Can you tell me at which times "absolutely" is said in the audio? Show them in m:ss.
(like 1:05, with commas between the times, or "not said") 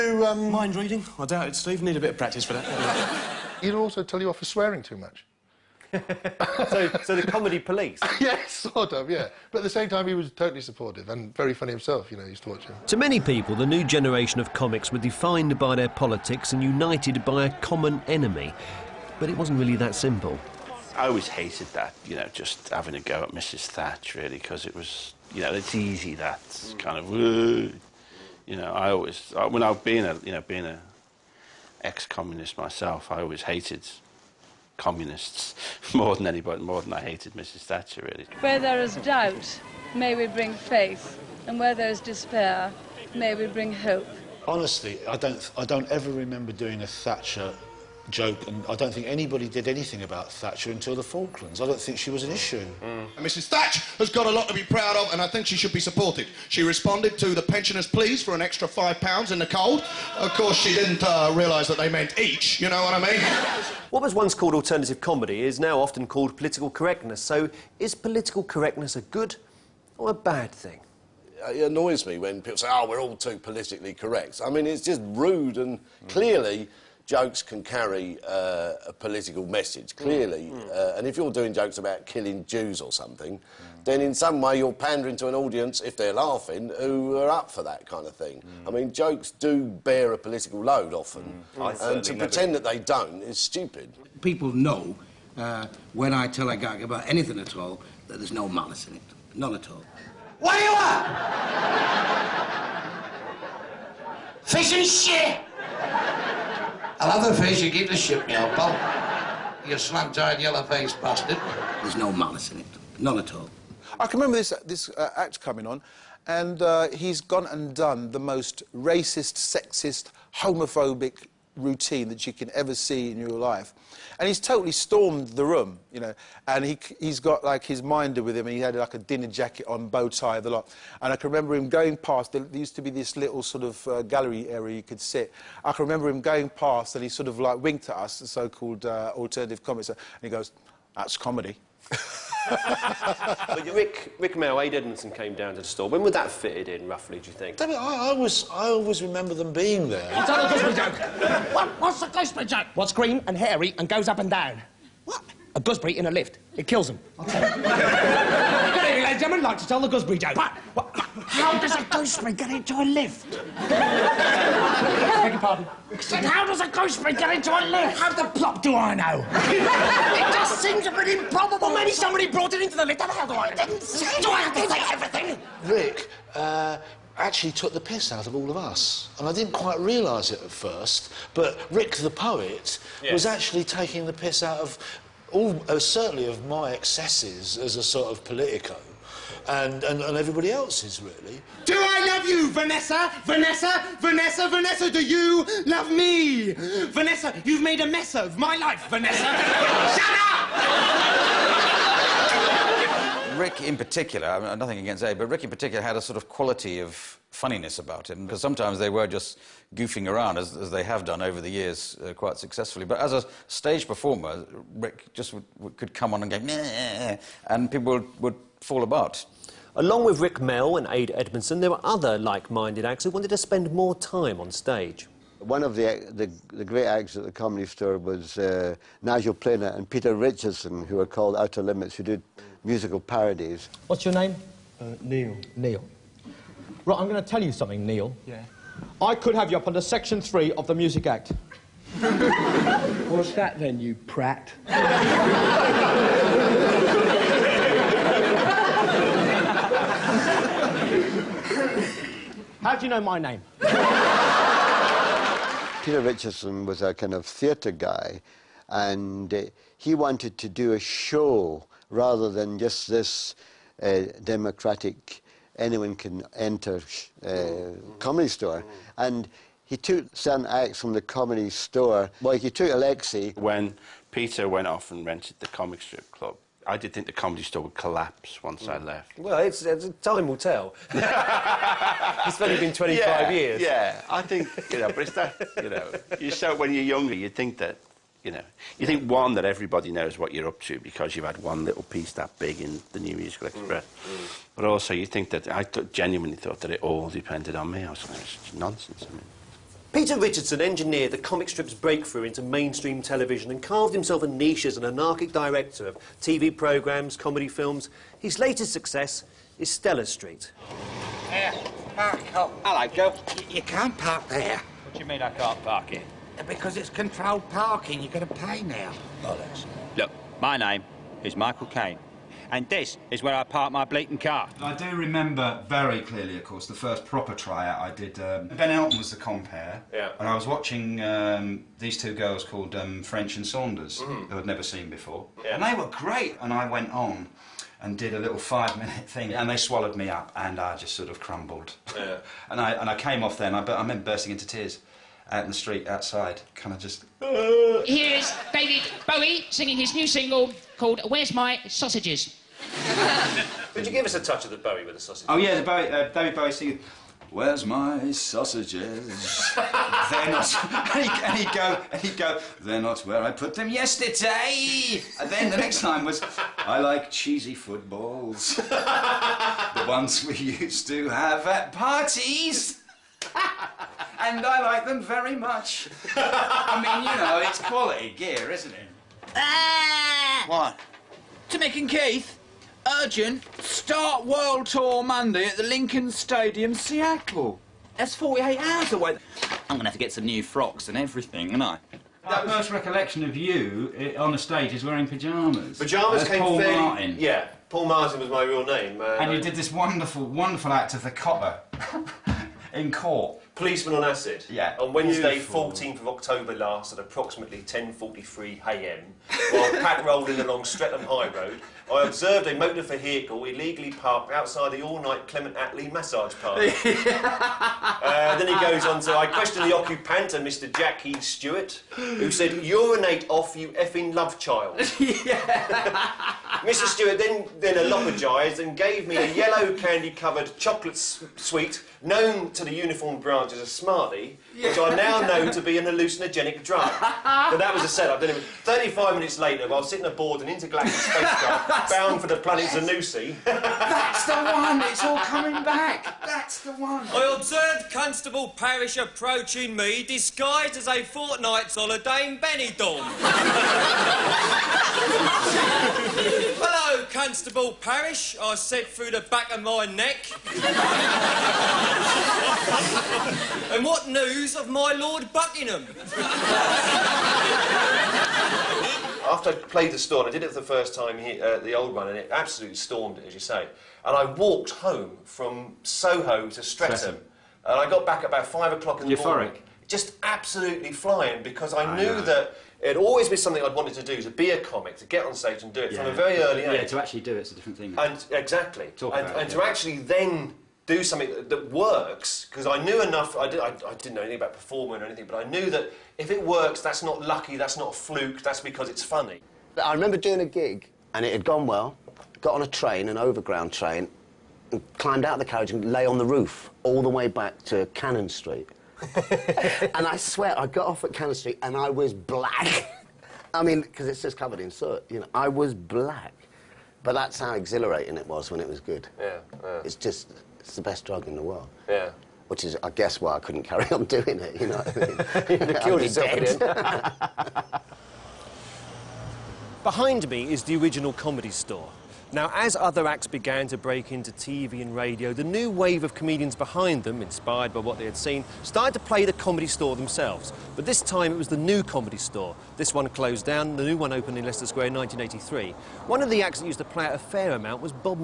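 7:52, 8:00.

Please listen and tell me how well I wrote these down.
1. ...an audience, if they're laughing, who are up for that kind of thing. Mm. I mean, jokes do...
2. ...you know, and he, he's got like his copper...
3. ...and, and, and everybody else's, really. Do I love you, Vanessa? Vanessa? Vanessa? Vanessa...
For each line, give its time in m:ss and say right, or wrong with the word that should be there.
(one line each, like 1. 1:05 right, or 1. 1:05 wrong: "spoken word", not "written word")
1. 1:25 right
2. 2:05 wrong: "minder", not "copper"
3. 3:09 right.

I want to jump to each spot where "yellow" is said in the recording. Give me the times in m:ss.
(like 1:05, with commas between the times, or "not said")
1:50, 7:09.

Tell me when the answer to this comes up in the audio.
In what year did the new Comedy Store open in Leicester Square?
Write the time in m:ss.
9:04.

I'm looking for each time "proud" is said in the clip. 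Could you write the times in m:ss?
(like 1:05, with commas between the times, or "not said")
0:54.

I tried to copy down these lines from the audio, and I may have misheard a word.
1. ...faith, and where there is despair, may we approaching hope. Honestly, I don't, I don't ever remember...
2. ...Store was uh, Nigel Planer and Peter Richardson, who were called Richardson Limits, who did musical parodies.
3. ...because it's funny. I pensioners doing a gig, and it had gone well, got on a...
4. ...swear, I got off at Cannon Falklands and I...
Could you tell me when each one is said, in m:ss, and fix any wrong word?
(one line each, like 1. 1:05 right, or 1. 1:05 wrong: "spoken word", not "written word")
1. 0:40 wrong: "bring", not "approaching"
2. 3:47 wrong: "Outer", not "Richardson"
3. 8:18 wrong: "remember", not "pensioners"
4. 8:30 wrong: "Street", not "Falklands".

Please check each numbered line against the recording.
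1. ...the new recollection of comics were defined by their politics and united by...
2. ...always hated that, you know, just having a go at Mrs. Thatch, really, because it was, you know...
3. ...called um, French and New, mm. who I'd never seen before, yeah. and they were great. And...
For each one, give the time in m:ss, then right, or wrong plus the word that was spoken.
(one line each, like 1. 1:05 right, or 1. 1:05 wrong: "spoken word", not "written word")
1. 0:13 wrong: "generation", not "recollection"
2. 0:21 right
3. 5:32 wrong: "Saunders", not "New".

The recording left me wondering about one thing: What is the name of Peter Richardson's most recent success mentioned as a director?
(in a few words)
Stella Street.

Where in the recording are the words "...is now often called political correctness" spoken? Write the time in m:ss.
1:05.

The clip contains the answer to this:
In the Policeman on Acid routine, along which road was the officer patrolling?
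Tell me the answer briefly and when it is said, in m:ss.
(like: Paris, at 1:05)
Streatham High Road, at 6:50.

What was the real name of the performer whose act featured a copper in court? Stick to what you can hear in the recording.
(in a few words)
Paul Martin.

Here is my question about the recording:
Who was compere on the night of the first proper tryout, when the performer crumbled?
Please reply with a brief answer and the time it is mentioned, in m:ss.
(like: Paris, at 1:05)
Ben Elton, at 5:28.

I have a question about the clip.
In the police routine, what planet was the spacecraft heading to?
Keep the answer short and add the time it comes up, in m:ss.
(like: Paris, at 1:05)
Zanussi, at 7:22.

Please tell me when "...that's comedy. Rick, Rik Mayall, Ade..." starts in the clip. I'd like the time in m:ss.
2:20.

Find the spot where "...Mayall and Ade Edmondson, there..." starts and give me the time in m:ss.
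3:40.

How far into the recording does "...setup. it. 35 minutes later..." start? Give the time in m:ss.
7:17.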